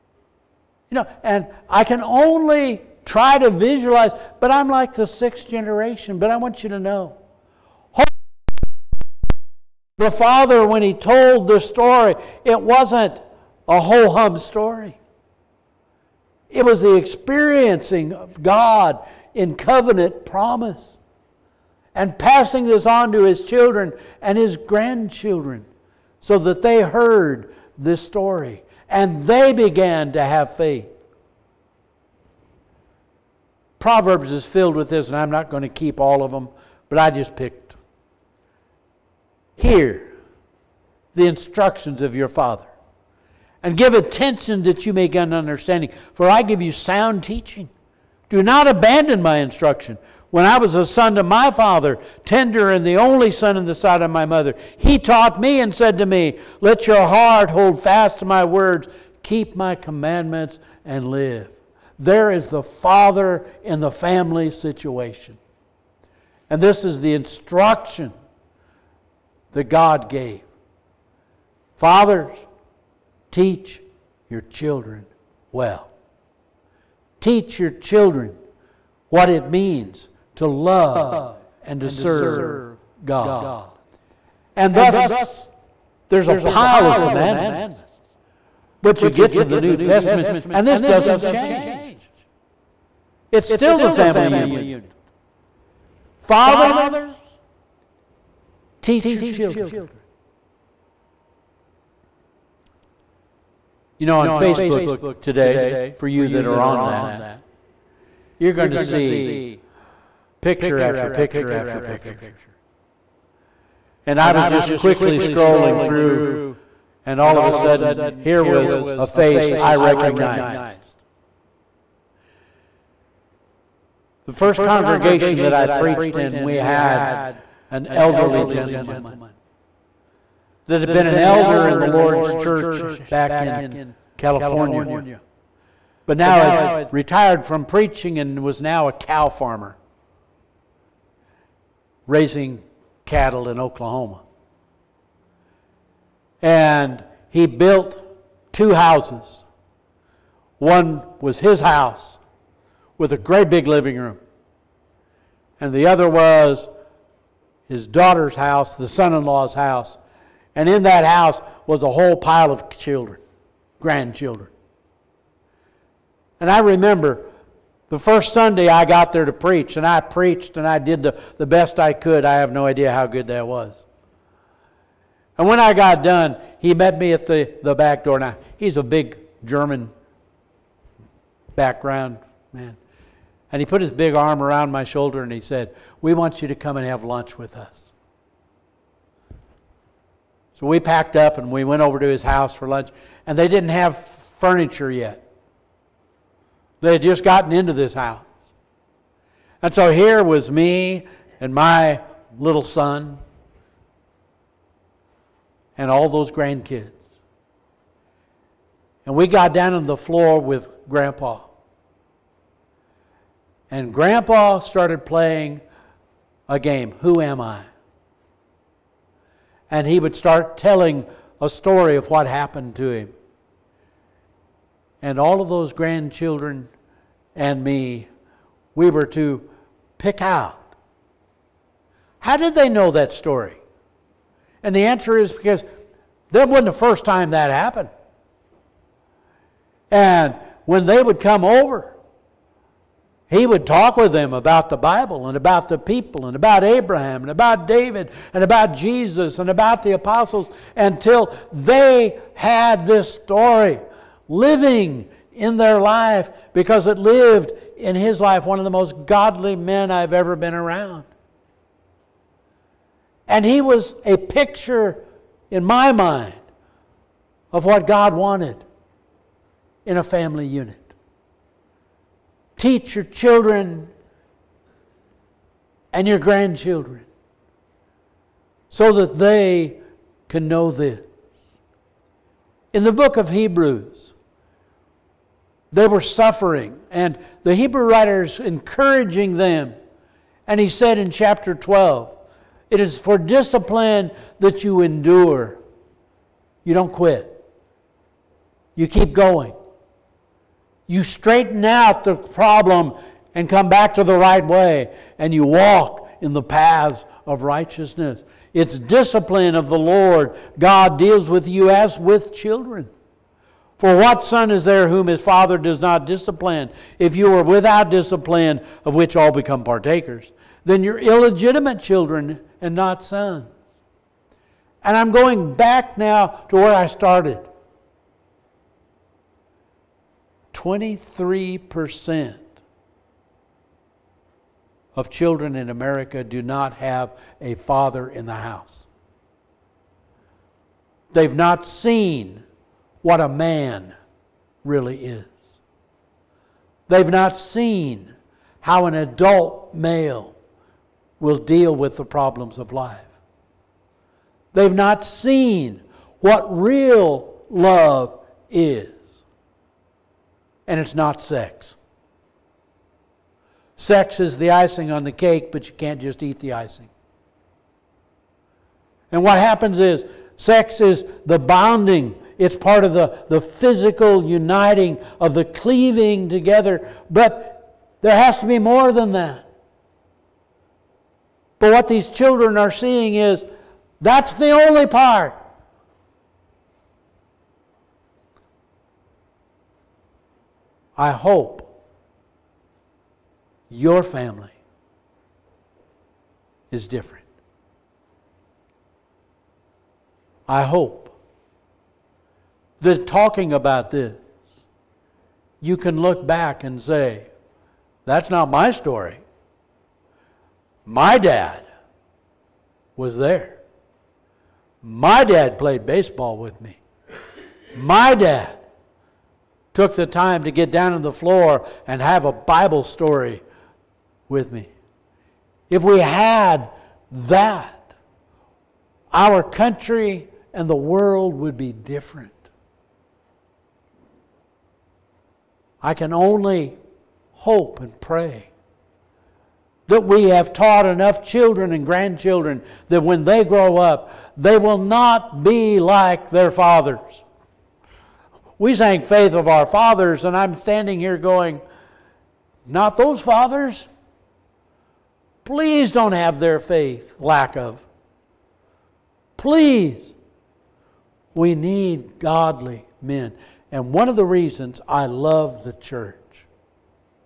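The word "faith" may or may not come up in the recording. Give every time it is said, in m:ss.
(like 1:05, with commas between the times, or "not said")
0:30, 7:29, 7:36.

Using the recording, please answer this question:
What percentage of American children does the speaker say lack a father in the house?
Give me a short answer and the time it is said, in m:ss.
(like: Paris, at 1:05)
23%, at 5:30.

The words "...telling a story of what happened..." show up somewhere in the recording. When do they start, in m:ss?
3:40.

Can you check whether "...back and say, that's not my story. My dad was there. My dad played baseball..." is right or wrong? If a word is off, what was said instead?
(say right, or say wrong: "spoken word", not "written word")
right.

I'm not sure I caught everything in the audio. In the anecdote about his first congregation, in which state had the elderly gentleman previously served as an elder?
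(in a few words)
California.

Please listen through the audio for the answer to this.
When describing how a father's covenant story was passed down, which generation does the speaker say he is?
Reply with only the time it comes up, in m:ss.
0:05.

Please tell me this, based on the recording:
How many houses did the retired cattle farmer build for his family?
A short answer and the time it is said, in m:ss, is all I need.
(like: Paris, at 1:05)
2, at 2:28.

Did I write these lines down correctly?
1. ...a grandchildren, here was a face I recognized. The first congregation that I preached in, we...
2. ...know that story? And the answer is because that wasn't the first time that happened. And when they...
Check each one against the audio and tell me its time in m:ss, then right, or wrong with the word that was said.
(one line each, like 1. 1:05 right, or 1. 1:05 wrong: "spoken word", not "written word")
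1. 1:57 wrong: "sudden", not "grandchildren"
2. 3:52 right.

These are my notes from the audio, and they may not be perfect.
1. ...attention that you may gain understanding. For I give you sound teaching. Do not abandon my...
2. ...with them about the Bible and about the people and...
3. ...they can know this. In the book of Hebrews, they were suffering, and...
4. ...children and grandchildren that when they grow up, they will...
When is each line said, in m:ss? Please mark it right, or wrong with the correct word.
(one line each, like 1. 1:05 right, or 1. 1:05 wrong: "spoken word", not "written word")
1. 0:43 right
2. 4:03 right
3. 4:39 right
4. 7:21 right.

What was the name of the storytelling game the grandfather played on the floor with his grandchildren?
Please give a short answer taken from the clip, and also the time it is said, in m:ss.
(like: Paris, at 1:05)
Who Am I?, at 3:36.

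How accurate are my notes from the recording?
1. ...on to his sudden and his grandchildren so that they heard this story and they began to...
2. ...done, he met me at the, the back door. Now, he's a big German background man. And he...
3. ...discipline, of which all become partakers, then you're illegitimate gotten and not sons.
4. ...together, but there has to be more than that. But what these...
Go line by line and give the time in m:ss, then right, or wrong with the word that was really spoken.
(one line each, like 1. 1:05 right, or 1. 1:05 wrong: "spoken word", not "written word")
1. 0:22 wrong: "children", not "sudden"
2. 2:56 right
3. 5:17 wrong: "children", not "gotten"
4. 6:16 right.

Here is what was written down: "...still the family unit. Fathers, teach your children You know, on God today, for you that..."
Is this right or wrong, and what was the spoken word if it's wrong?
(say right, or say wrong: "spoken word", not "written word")
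wrong: "Facebook", not "God".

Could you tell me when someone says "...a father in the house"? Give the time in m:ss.
5:37.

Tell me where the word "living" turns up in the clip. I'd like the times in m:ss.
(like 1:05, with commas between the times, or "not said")
2:33, 4:14.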